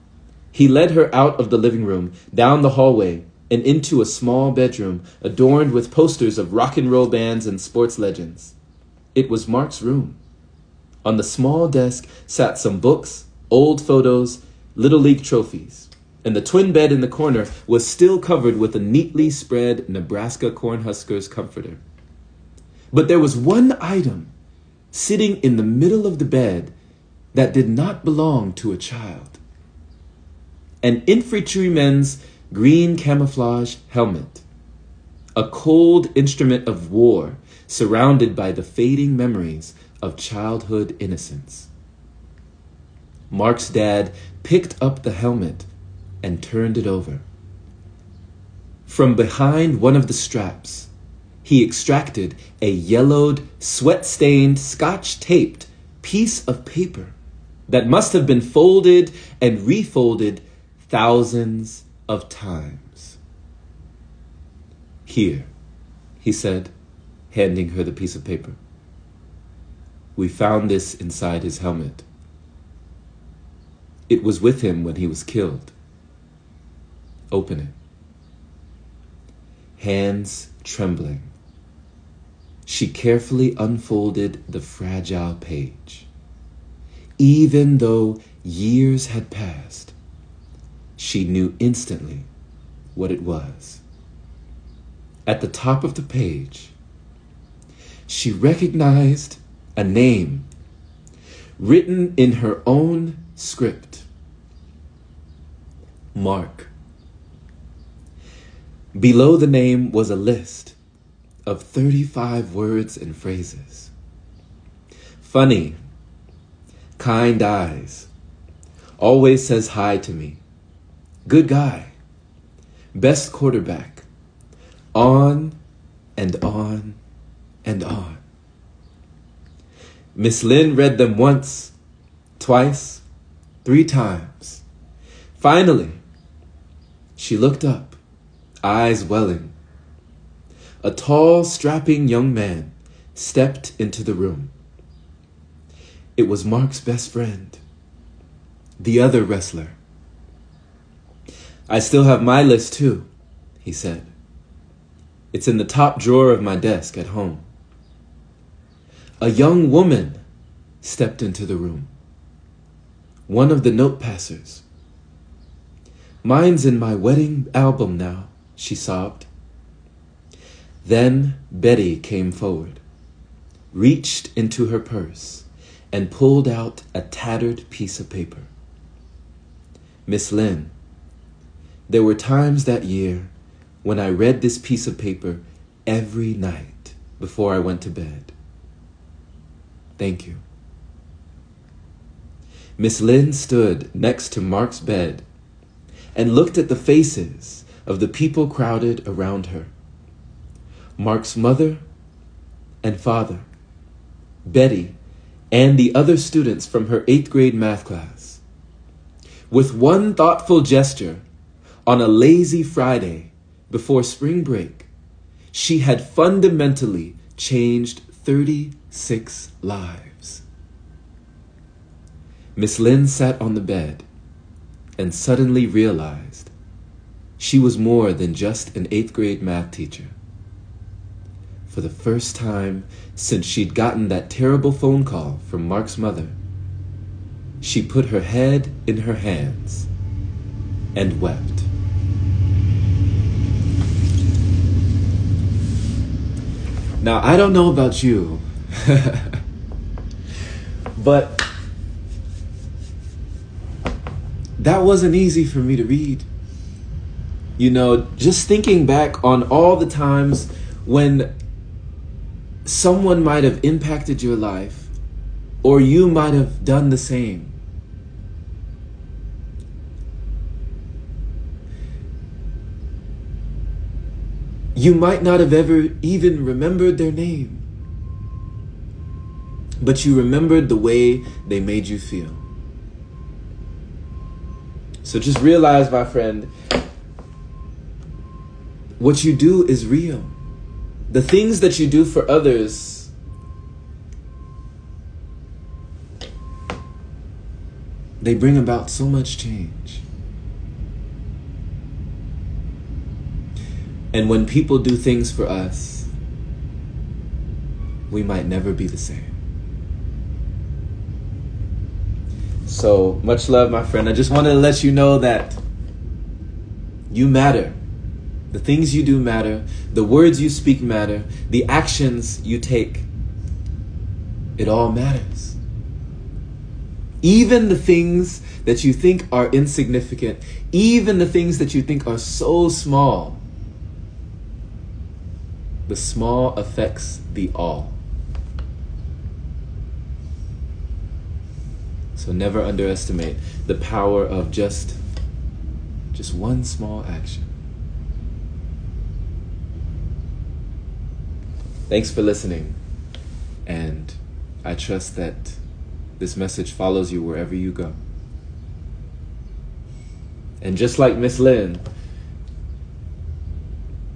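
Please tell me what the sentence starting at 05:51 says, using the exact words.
Thanks for listening, and I trust that this message follows you wherever you go.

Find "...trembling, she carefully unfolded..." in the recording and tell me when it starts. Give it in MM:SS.
01:20.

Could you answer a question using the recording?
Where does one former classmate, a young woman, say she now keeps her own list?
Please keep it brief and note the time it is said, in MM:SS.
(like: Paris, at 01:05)
Wedding album, at 02:46.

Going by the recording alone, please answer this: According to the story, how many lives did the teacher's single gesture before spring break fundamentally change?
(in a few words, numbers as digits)
36.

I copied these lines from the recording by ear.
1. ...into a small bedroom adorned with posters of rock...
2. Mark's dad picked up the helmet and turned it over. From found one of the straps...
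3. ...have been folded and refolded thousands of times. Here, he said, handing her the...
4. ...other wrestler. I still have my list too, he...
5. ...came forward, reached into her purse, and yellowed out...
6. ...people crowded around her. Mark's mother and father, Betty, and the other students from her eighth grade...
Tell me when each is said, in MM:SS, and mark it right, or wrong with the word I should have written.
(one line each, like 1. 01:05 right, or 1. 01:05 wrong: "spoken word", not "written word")
1. 00:03 right
2. 00:43 wrong: "behind", not "found"
3. 00:58 right
4. 02:29 right
5. 02:51 wrong: "pulled", not "yellowed"
6. 03:18 right.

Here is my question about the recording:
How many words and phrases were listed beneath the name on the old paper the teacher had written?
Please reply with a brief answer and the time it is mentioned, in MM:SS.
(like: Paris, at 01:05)
35, at 01:51.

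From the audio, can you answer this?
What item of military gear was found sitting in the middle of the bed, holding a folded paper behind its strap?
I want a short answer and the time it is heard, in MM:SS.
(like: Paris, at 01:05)
Camouflage helmet, at 00:32.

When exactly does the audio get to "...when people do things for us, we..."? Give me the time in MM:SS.
05:04.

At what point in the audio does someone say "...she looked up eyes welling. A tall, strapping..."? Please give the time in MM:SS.
02:17.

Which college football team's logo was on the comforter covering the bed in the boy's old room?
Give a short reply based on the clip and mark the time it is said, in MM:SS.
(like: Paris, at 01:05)
Nebraska Cornhuskers, at 00:19.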